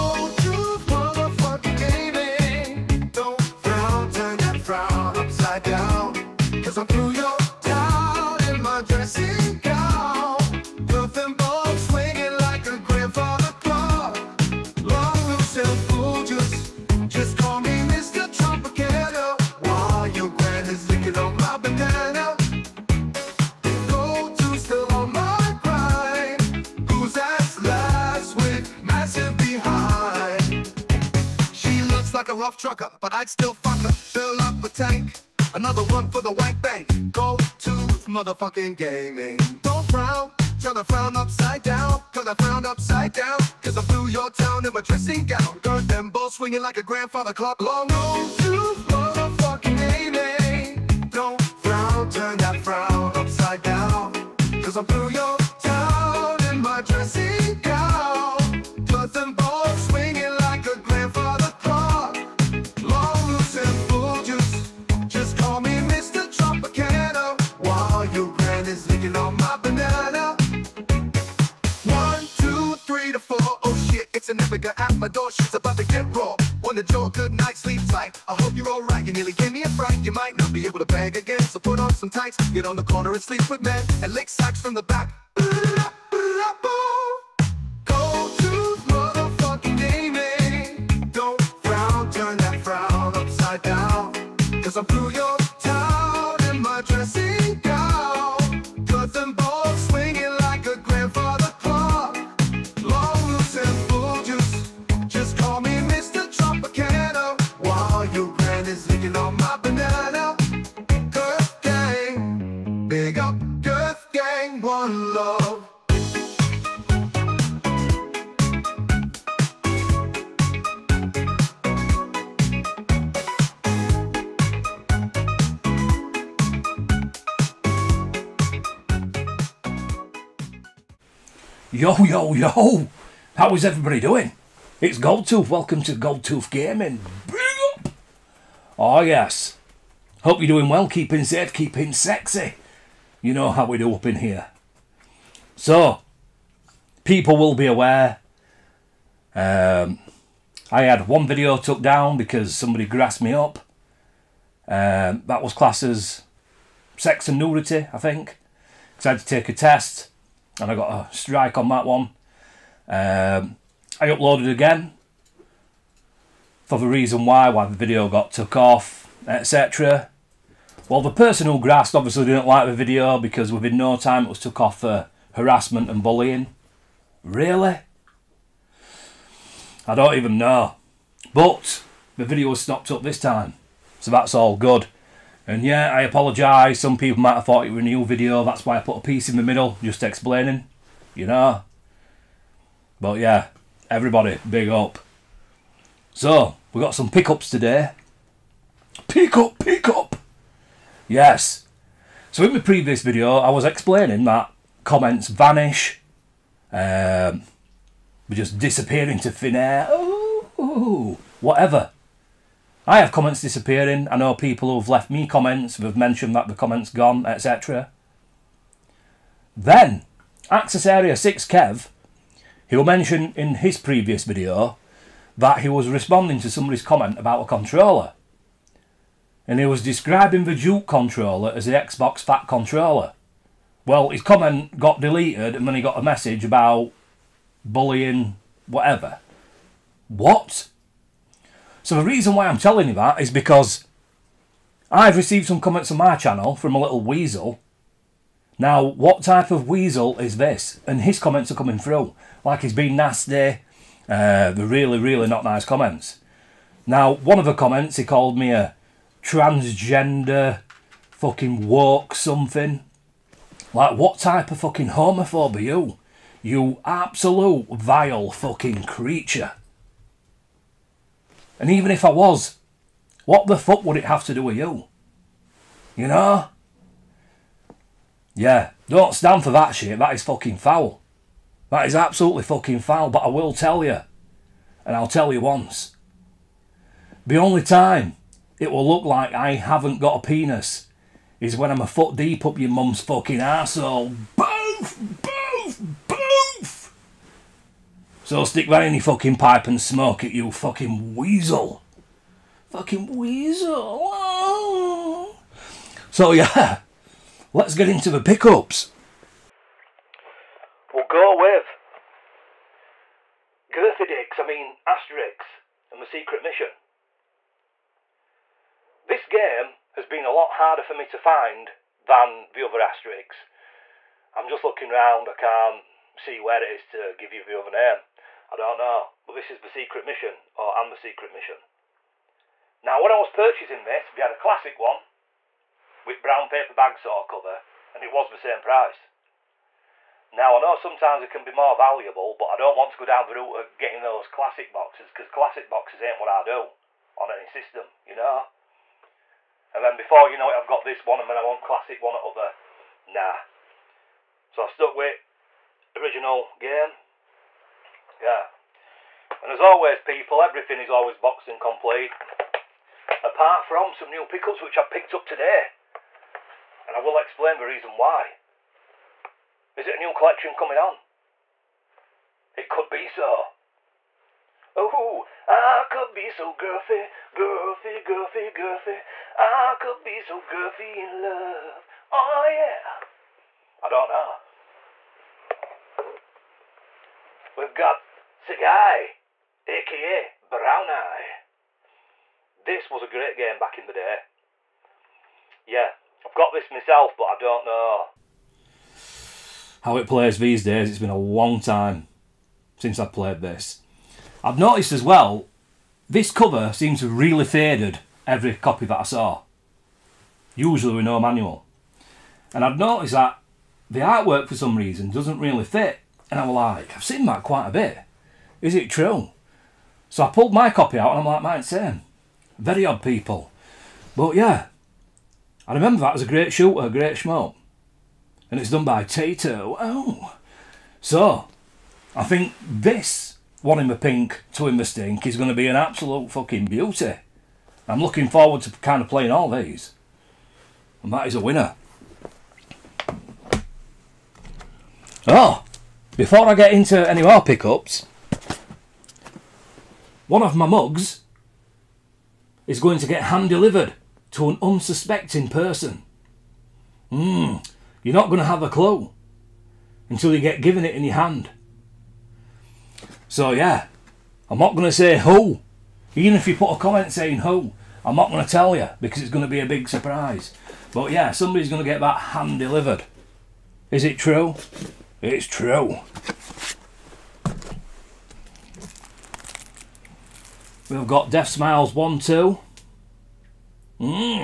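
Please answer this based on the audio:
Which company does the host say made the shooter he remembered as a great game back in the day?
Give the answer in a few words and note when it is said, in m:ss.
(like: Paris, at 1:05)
Taito, at 7:09.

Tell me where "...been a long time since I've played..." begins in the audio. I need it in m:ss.
6:40.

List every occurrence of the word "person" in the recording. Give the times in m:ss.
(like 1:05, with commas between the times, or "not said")
2:51, 7:35.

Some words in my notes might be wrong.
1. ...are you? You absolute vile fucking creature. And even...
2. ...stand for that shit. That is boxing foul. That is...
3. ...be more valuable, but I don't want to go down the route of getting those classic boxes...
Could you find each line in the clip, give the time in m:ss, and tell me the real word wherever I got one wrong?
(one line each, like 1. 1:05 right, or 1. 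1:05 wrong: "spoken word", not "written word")
1. 4:25 right
2. 4:39 wrong: "fucking", not "boxing"
3. 5:41 right.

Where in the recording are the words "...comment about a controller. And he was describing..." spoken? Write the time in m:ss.
3:46.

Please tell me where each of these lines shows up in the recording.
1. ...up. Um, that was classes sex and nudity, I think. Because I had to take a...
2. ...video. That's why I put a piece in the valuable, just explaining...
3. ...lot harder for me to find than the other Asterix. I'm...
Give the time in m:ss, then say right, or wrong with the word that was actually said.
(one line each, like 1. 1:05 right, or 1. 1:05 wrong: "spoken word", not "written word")
1. 2:33 right
2. 3:08 wrong: "middle", not "valuable"
3. 5:20 right.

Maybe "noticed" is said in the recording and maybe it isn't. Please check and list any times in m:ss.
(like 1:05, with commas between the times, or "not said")
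6:44, 6:52.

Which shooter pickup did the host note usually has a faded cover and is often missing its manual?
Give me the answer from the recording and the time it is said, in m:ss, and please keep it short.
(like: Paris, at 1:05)
Sagaia, at 6:28.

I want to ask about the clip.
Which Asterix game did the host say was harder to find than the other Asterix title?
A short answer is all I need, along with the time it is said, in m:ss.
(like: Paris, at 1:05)
Asterix and the Secret Mission, at 5:14.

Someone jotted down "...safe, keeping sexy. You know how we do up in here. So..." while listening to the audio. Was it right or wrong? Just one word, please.
right.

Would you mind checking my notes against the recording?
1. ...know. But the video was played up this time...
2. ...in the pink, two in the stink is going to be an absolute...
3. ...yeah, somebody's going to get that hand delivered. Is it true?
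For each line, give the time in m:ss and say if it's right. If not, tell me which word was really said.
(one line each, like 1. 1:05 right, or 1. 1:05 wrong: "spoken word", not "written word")
1. 3:00 wrong: "stopped", not "played"
2. 7:13 right
3. 7:51 right.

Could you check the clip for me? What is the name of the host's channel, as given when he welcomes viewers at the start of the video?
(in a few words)
Goldtooth Gaming.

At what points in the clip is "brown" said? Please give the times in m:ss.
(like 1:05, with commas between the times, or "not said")
5:36, 6:30.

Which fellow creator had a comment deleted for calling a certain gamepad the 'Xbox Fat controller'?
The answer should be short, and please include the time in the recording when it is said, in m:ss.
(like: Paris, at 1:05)
Access Area 6 Kev, at 3:40.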